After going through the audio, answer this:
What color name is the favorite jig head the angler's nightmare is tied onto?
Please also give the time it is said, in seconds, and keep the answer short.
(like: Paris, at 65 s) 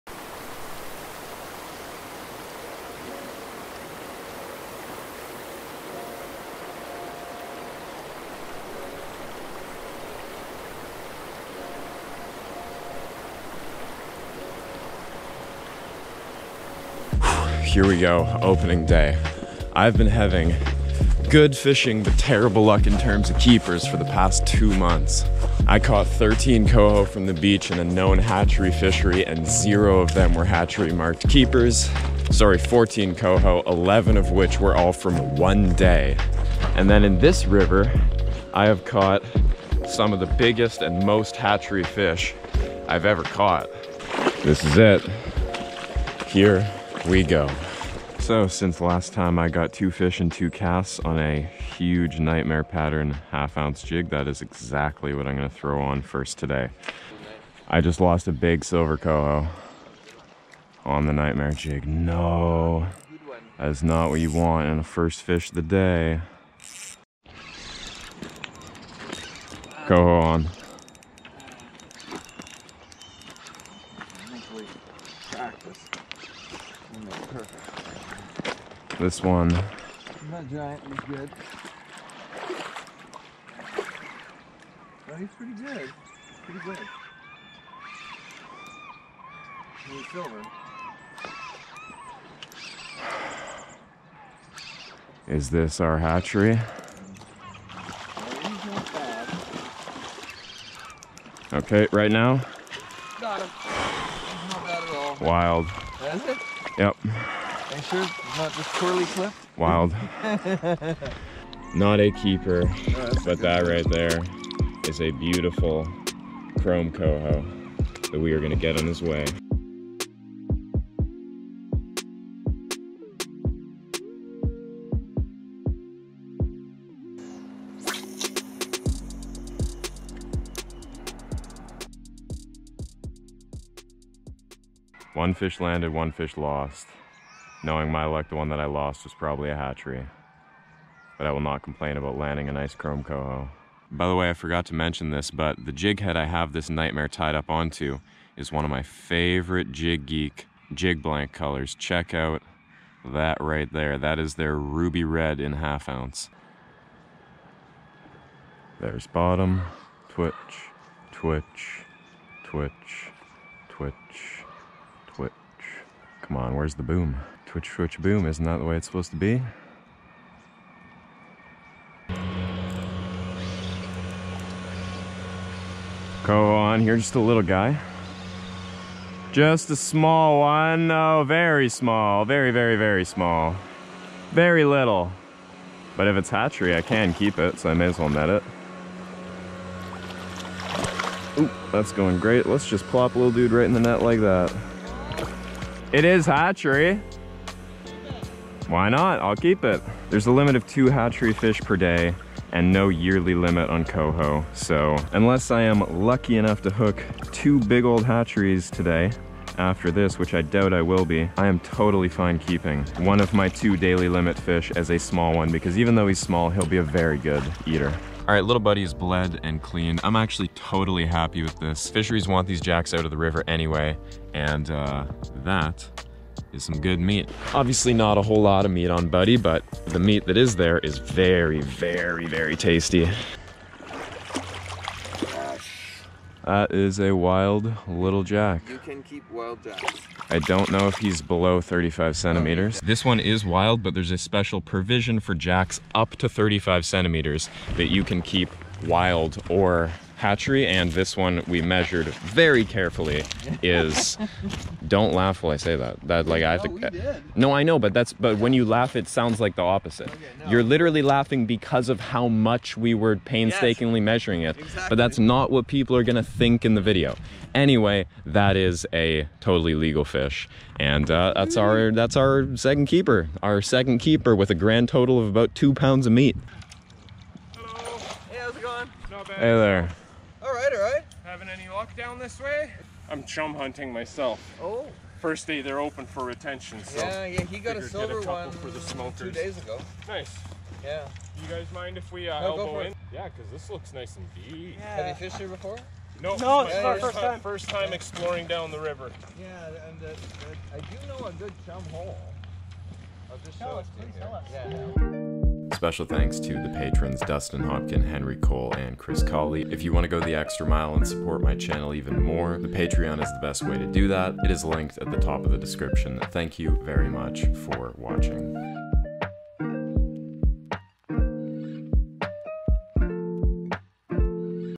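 ruby red, at 154 s.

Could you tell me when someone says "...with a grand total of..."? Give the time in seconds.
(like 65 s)
274 s.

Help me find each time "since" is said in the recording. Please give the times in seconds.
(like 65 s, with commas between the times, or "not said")
48 s.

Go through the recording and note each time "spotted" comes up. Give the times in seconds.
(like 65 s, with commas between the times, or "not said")
not said.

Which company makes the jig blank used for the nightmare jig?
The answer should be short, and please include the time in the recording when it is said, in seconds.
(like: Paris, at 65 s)
Jig Geek, at 149 s.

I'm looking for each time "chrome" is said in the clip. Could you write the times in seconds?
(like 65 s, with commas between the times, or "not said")
116 s, 142 s.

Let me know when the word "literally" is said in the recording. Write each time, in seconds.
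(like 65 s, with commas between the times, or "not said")
260 s.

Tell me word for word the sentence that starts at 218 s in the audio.
All right, little buddy is bled and cleaned.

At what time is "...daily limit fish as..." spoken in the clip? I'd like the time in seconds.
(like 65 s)
213 s.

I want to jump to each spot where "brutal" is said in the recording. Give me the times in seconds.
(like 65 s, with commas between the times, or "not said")
not said.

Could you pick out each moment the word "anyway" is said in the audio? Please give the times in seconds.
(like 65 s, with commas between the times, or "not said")
223 s, 267 s.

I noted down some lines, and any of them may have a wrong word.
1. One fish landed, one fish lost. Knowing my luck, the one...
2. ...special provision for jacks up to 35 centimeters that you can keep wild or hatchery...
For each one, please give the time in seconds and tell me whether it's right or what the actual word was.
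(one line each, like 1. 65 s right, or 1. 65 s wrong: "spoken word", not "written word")
1. 135 s right
2. 244 s right.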